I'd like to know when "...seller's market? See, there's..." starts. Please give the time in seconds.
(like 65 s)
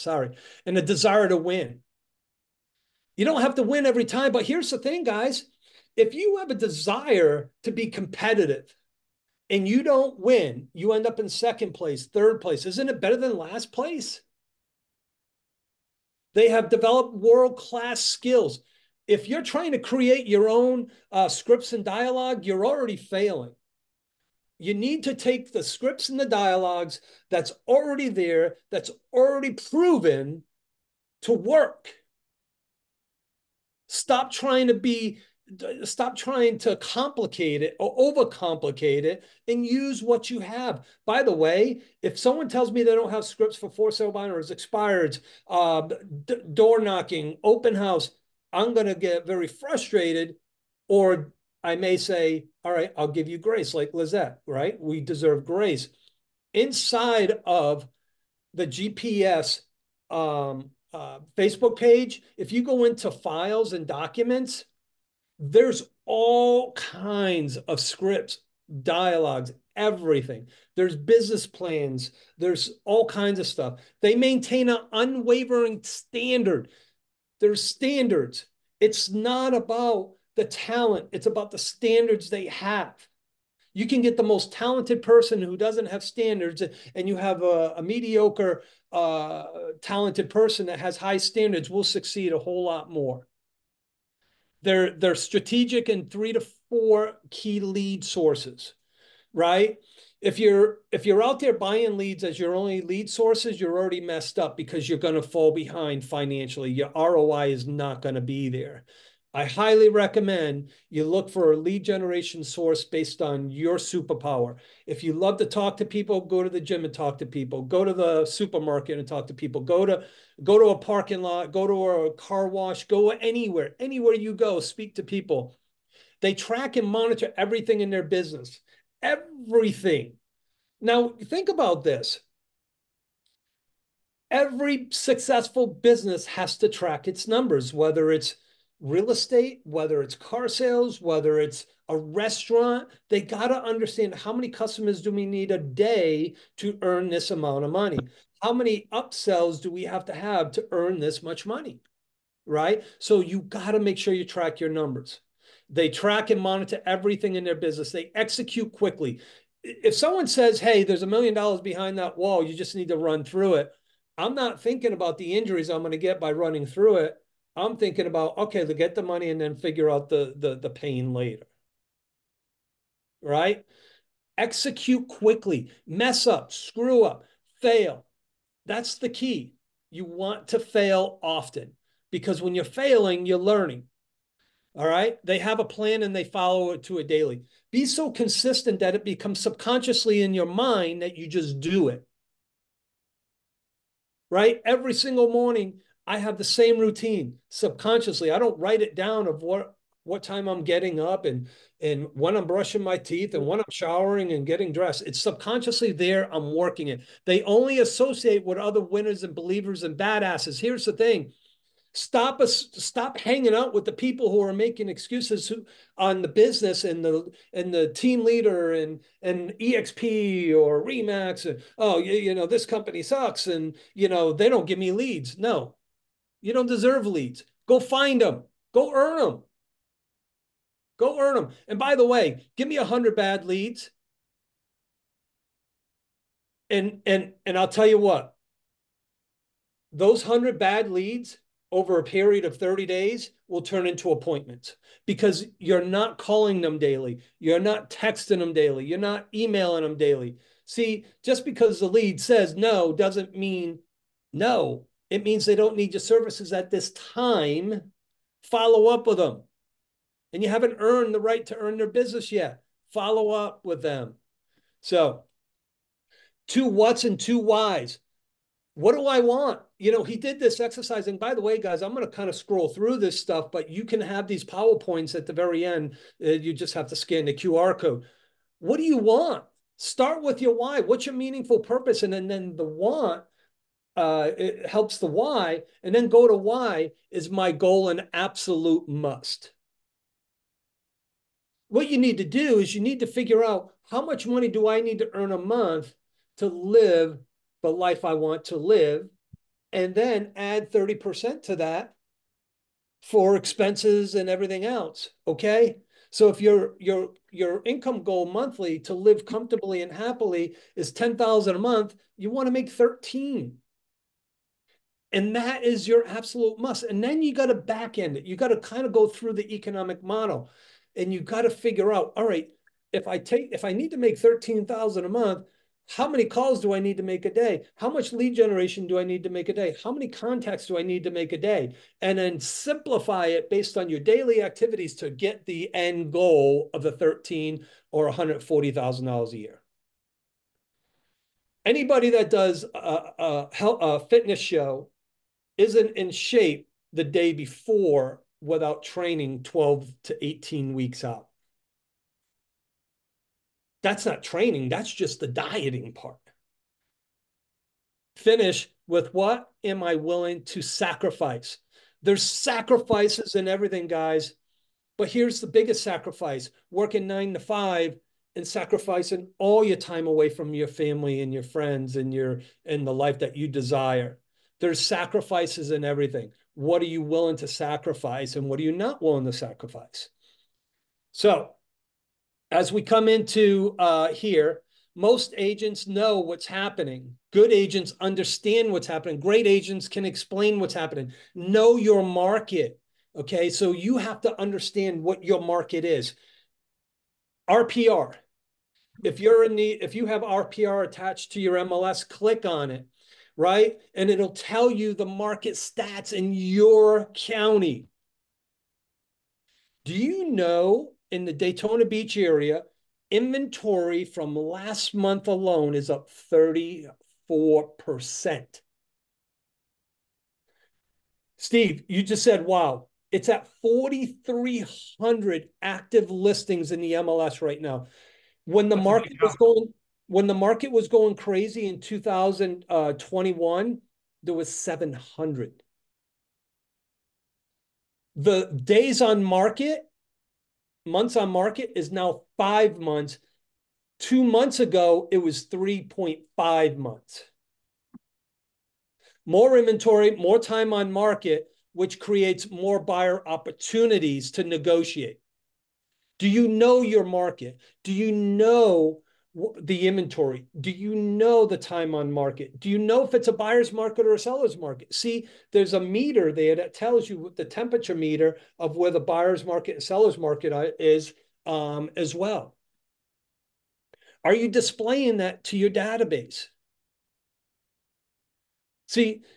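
464 s.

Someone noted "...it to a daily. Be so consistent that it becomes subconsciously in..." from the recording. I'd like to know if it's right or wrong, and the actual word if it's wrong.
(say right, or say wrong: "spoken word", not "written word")
right.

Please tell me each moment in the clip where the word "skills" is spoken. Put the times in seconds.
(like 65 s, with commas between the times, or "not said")
17 s.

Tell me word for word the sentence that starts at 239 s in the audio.
Those 100 bad leads over a period of 30 days will turn into appointments because you're not calling them daily.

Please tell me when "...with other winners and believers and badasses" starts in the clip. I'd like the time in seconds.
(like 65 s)
208 s.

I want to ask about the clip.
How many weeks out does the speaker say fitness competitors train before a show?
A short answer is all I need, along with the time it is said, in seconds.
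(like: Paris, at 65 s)
12 to 18, at 349 s.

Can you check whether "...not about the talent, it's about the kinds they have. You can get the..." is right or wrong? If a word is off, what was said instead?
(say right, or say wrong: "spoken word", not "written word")
wrong: "standards", not "kinds".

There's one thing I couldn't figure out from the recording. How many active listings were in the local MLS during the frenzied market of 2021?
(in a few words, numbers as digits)
700.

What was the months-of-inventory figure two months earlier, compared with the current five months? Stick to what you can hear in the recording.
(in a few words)
3.5 months.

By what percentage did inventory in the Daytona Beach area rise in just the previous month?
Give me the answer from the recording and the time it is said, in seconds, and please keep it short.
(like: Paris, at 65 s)
34%, at 416 s.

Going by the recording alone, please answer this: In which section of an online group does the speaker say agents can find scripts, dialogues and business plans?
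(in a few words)
files and documents.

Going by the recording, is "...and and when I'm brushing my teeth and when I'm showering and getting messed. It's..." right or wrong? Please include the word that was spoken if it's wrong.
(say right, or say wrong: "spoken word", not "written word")
wrong: "dressed", not "messed".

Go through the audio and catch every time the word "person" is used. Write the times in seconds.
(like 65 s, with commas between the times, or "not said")
85 s, 90 s.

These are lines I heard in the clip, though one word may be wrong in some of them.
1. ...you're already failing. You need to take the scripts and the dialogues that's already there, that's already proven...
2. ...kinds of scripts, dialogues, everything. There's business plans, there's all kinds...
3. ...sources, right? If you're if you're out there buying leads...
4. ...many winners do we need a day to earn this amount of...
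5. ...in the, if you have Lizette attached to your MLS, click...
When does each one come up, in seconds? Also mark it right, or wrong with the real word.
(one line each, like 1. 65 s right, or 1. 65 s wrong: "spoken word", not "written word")
1. 22 s right
2. 66 s right
3. 98 s right
4. 144 s wrong: "customers", not "winners"
5. 399 s wrong: "RPR", not "Lizette".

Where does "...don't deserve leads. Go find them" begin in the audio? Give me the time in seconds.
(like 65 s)
226 s.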